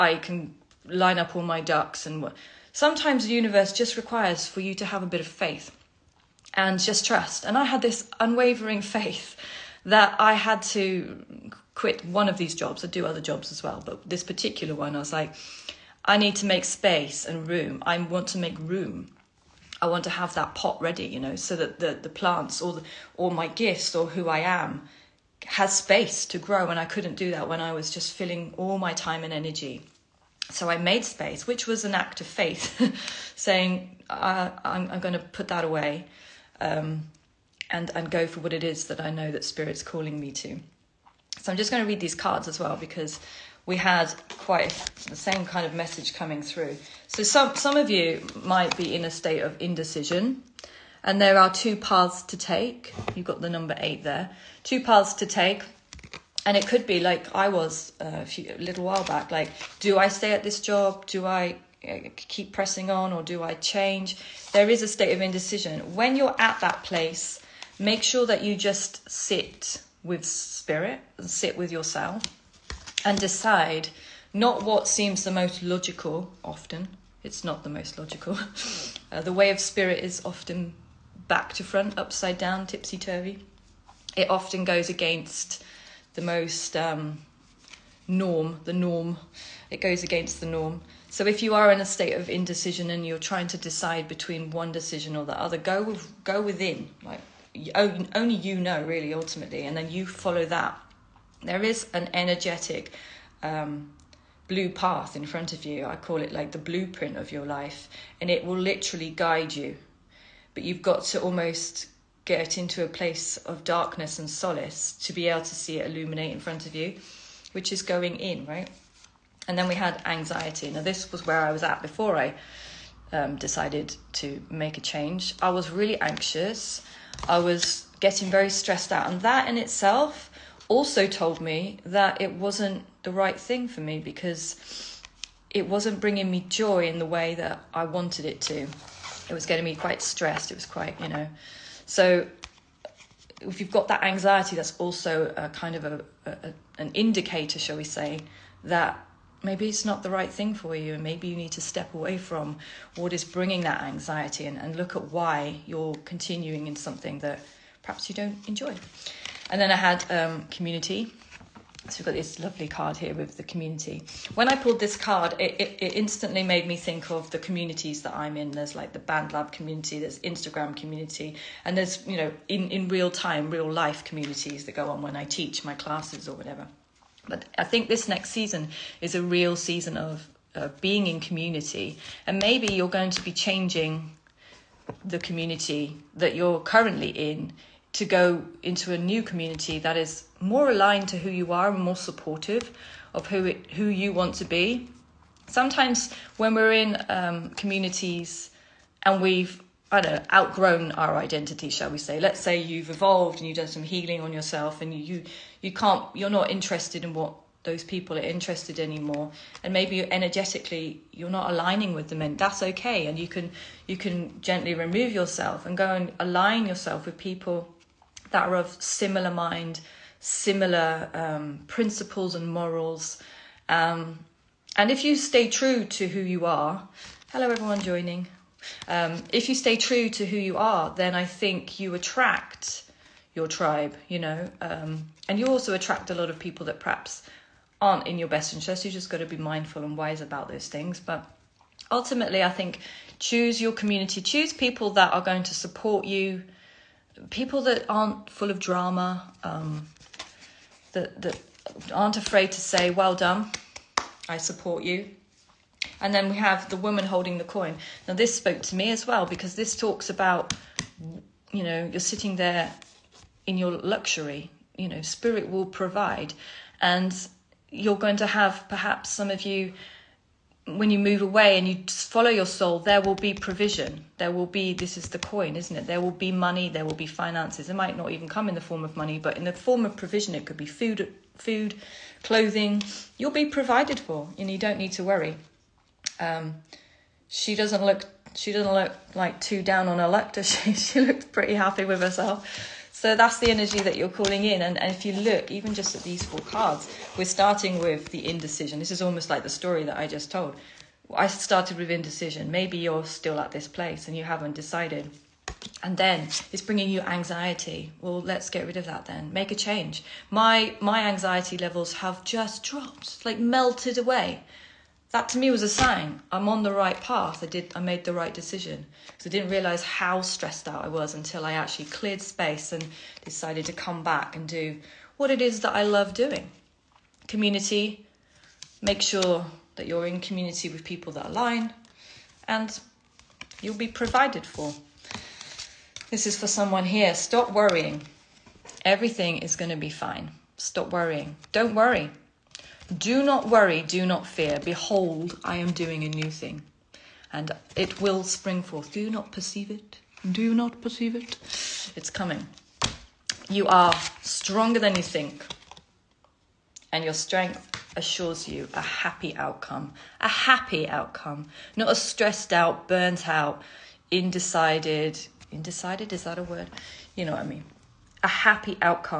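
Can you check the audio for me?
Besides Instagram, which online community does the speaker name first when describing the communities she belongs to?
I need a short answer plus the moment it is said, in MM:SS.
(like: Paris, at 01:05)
BandLab, at 02:48.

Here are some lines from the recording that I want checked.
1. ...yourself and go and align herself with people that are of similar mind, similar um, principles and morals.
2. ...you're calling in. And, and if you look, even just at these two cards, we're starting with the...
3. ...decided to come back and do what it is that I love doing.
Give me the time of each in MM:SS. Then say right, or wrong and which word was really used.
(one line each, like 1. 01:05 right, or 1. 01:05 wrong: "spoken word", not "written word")
1. 03:35 wrong: "yourself", not "herself"
2. 04:53 wrong: "four", not "two"
3. 05:23 right.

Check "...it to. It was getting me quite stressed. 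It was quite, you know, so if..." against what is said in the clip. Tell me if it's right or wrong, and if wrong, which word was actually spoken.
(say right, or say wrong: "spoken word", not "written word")
right.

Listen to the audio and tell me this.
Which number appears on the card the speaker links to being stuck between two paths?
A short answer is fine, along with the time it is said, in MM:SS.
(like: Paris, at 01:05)
8, at 00:53.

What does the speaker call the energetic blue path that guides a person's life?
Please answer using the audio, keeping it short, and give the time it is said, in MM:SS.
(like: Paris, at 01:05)
the blueprint of your life, at 01:46.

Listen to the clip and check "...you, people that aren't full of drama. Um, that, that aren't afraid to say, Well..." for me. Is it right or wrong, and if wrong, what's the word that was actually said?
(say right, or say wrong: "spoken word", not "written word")
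right.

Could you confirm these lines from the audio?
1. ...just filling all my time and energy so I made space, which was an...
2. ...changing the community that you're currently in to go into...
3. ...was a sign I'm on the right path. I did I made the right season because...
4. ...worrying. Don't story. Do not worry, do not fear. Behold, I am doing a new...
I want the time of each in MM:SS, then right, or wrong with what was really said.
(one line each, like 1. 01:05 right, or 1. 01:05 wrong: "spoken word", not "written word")
1. 00:27 right
2. 03:03 right
3. 05:15 wrong: "decision", not "season"
4. 05:40 wrong: "worry", not "story".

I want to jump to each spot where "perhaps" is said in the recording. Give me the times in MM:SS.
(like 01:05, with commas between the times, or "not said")
02:37, 03:56, 04:28.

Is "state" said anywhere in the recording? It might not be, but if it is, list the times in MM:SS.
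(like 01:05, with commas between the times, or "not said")
00:49, 01:04, 01:31.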